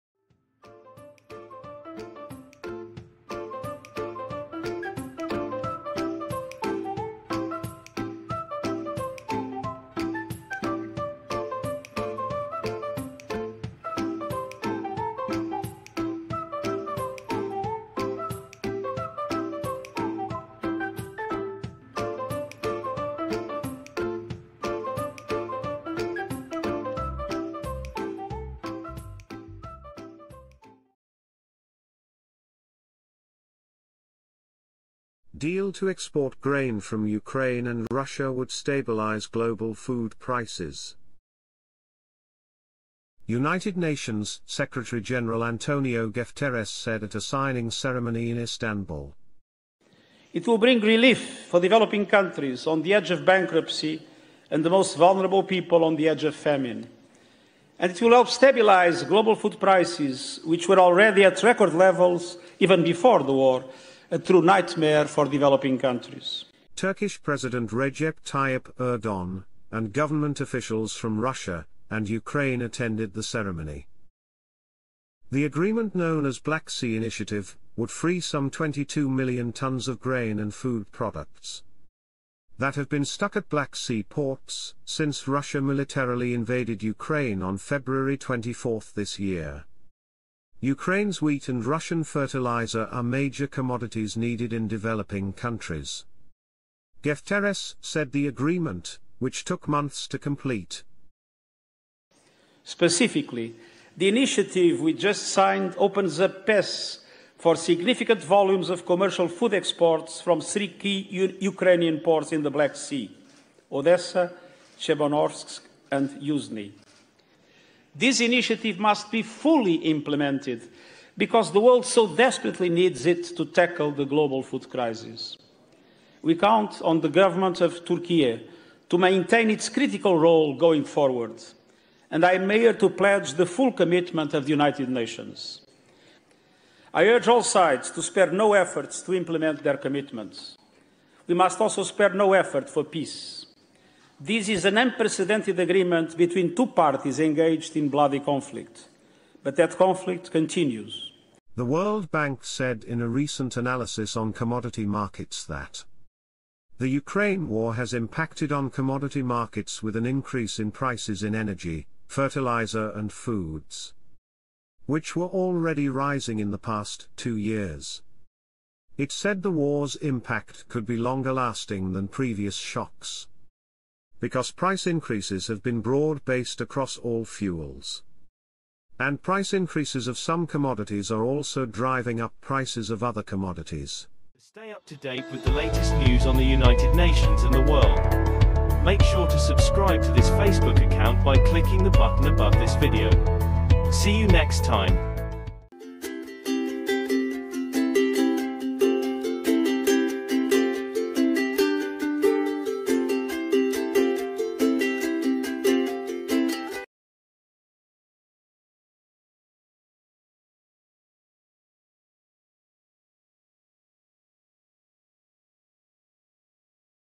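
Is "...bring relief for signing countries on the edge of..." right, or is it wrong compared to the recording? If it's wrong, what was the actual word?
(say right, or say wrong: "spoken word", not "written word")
wrong: "developing", not "signing".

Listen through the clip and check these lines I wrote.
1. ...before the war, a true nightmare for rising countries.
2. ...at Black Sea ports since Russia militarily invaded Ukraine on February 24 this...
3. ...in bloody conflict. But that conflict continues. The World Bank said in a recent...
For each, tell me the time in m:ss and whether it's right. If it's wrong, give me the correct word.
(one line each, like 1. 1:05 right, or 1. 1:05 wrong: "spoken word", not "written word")
1. 1:02 wrong: "developing", not "rising"
2. 1:23 right
3. 2:27 right.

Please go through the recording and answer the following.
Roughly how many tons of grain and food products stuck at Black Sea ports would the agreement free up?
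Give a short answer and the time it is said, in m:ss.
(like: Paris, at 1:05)
22 million tons, at 1:18.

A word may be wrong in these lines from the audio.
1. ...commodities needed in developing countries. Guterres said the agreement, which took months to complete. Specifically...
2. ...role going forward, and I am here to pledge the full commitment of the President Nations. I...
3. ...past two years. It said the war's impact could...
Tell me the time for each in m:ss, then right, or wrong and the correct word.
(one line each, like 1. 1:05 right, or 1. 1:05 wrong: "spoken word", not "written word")
1. 1:33 right
2. 2:10 wrong: "United", not "President"
3. 2:46 right.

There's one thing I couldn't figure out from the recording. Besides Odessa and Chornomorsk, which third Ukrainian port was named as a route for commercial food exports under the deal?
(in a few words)
Yuzny.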